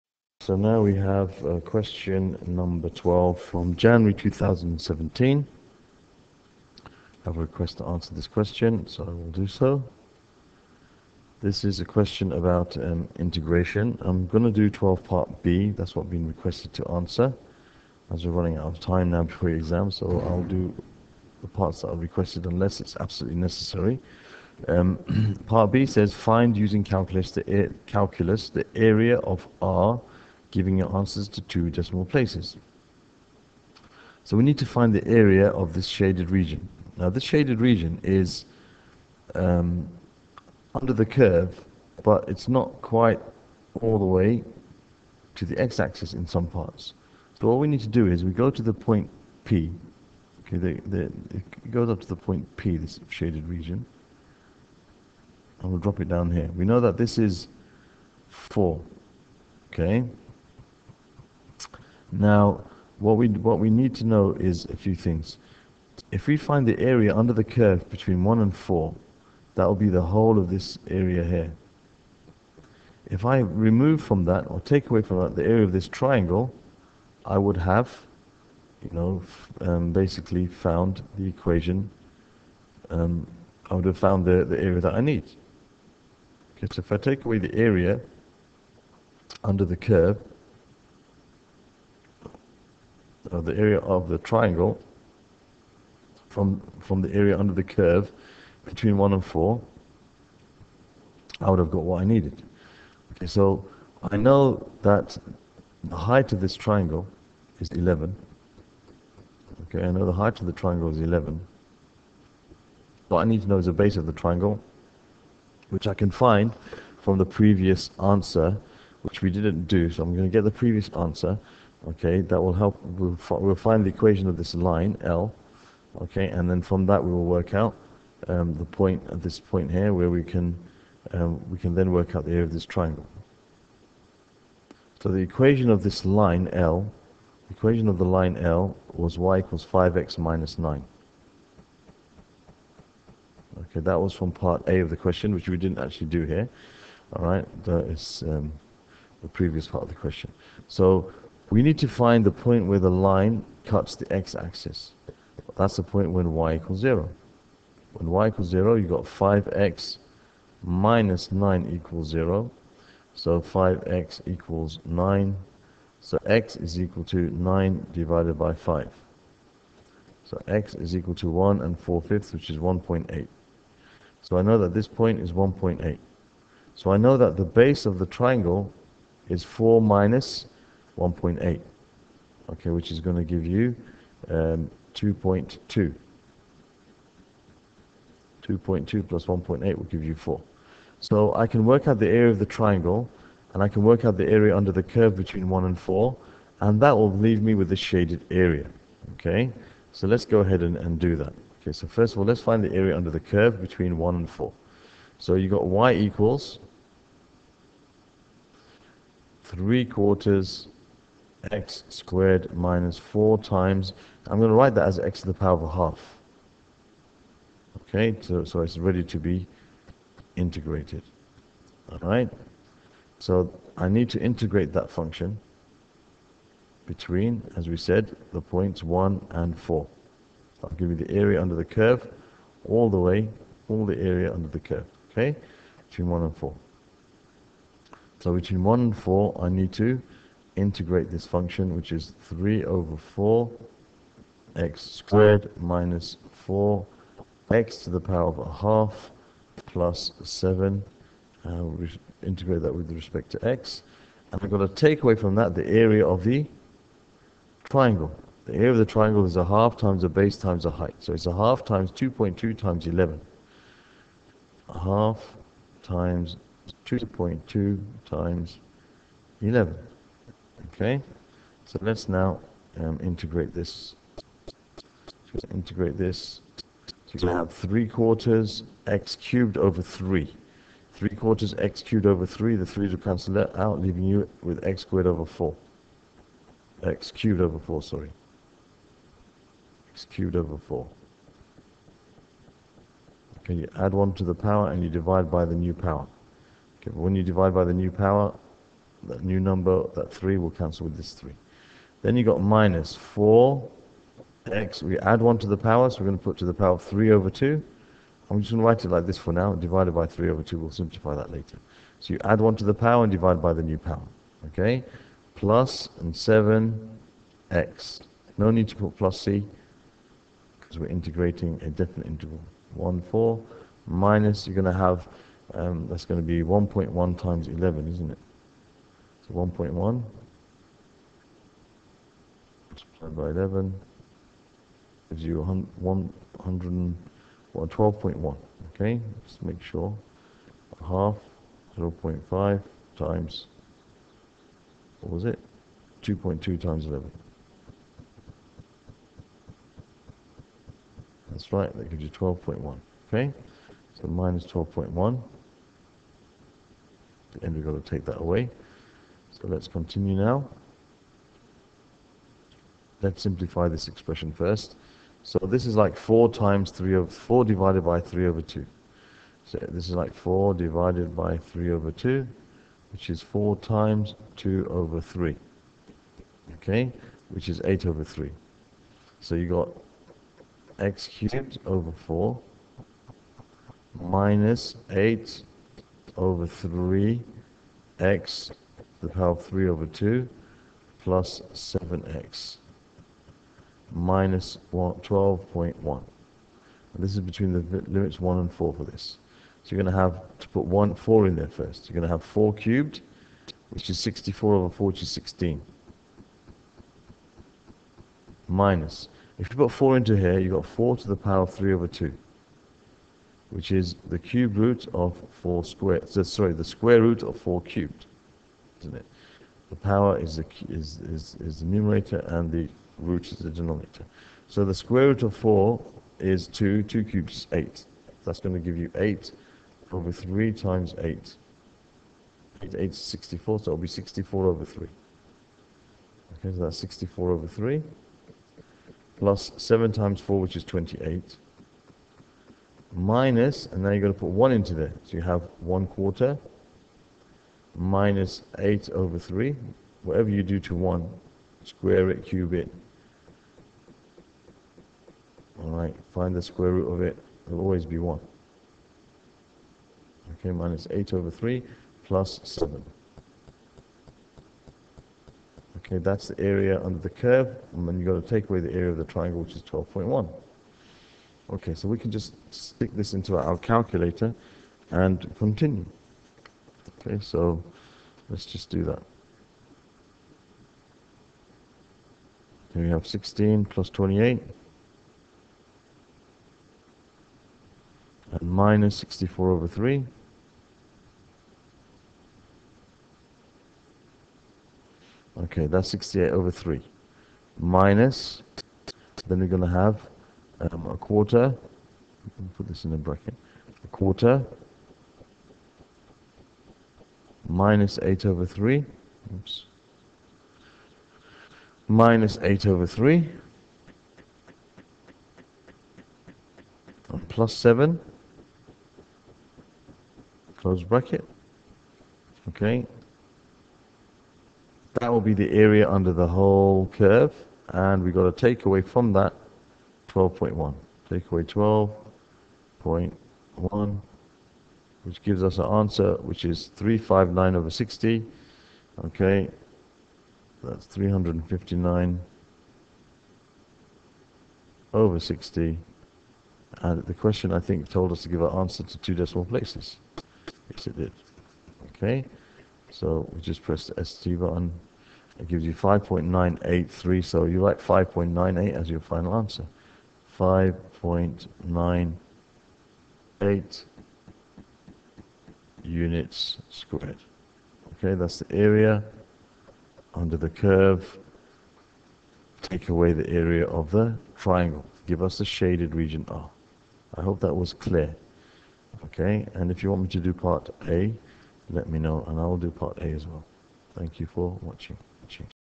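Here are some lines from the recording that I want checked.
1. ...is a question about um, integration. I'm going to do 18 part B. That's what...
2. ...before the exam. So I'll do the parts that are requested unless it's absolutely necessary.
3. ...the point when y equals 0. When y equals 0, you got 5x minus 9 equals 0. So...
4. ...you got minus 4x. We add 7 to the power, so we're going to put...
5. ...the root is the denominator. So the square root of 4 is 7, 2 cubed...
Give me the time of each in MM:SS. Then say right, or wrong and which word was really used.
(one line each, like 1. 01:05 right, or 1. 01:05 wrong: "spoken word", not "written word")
1. 00:11 wrong: "12", not "18"
2. 00:19 right
3. 02:35 right
4. 05:02 wrong: "1", not "7"
5. 07:02 wrong: "2", not "7".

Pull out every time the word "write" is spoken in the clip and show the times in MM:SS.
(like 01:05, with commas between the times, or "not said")
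03:34, 05:08, 09:17.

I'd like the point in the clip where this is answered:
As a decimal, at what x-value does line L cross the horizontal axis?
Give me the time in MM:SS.
02:52.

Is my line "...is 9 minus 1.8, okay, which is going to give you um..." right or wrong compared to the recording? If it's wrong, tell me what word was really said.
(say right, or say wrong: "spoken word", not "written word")
wrong: "4", not "9".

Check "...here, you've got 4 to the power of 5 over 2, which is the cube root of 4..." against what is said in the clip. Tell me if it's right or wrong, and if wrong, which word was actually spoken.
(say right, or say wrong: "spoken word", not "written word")
wrong: "3", not "5".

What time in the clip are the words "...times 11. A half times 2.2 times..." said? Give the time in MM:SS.
04:22.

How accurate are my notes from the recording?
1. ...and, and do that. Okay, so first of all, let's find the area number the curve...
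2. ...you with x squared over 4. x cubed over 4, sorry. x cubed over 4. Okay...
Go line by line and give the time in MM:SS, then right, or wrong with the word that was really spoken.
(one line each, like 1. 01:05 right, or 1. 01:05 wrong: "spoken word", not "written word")
1. 03:20 wrong: "under", not "number"
2. 04:44 right.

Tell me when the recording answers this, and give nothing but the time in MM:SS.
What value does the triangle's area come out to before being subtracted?
05:51.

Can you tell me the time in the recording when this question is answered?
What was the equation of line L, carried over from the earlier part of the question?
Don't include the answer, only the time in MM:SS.
02:19.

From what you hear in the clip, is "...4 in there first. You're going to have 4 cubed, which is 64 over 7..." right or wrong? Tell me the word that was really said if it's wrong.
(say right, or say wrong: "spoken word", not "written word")
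wrong: "4", not "7".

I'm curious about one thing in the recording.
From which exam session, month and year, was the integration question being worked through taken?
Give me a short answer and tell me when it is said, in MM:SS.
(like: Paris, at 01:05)
January 2017, at 00:03.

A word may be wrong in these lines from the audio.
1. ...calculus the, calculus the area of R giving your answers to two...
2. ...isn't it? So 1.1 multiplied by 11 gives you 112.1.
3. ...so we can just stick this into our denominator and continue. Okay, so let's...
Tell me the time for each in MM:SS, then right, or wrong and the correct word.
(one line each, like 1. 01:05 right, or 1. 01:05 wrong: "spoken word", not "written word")
1. 00:26 right
2. 05:27 right
3. 07:51 wrong: "calculator", not "denominator".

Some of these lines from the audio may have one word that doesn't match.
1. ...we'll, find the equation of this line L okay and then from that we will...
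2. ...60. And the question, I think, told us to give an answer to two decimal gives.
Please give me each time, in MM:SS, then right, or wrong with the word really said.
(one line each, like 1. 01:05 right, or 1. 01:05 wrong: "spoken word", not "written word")
1. 02:03 right
2. 09:05 wrong: "places", not "gives".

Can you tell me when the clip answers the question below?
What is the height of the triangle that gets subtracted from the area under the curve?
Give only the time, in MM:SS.
01:45.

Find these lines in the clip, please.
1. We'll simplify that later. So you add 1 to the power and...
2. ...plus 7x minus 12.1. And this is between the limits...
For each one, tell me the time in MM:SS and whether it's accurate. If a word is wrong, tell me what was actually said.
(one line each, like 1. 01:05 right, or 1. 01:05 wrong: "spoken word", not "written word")
1. 05:10 right
2. 06:30 right.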